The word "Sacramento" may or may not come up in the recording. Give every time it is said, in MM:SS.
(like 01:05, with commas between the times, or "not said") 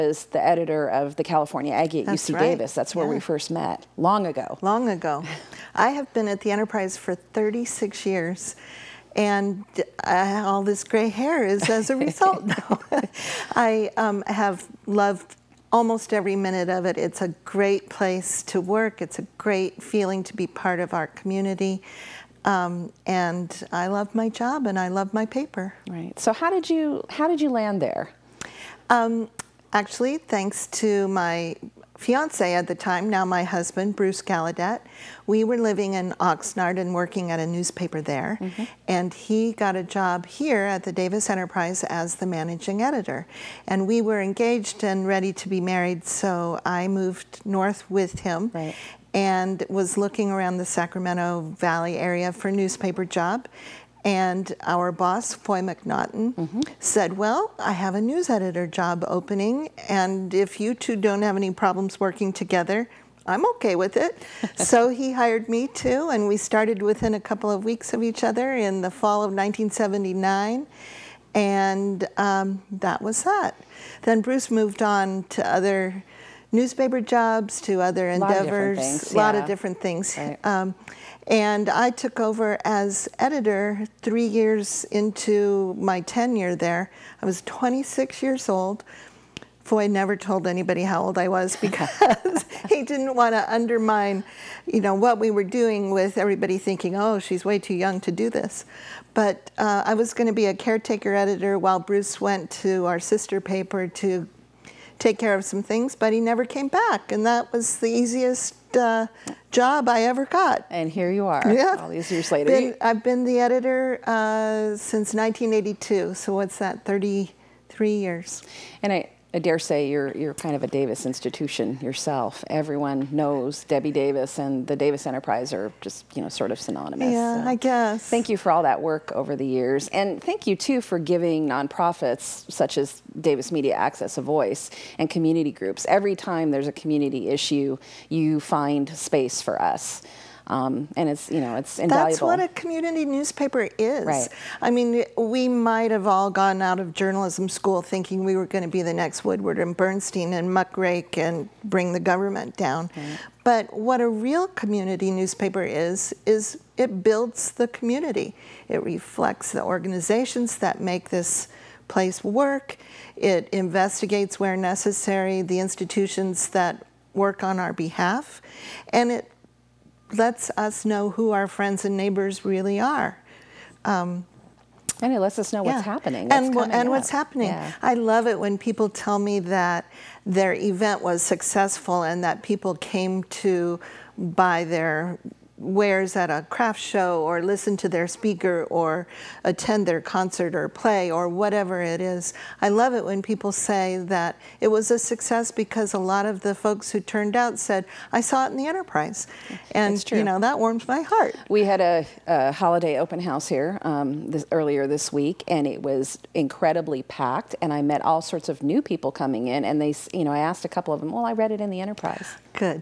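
00:50.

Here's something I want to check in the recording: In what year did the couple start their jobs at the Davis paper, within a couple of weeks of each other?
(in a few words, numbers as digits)
1979.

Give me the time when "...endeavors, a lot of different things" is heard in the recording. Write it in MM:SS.
01:18.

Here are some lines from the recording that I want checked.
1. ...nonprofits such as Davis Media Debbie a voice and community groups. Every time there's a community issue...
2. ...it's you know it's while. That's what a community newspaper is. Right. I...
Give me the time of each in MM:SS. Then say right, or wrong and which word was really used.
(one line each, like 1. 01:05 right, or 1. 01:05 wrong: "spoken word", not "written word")
1. 02:11 wrong: "Access", not "Debbie"
2. 02:21 wrong: "invaluable", not "while".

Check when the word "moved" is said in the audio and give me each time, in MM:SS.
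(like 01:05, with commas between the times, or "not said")
00:46, 01:14.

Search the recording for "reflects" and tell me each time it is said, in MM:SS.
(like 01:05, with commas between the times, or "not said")
02:38.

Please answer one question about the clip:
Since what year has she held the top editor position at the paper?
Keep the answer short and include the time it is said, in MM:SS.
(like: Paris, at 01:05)
1982, at 01:55.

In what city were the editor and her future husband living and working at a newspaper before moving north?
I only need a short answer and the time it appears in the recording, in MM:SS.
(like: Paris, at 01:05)
Oxnard, at 00:36.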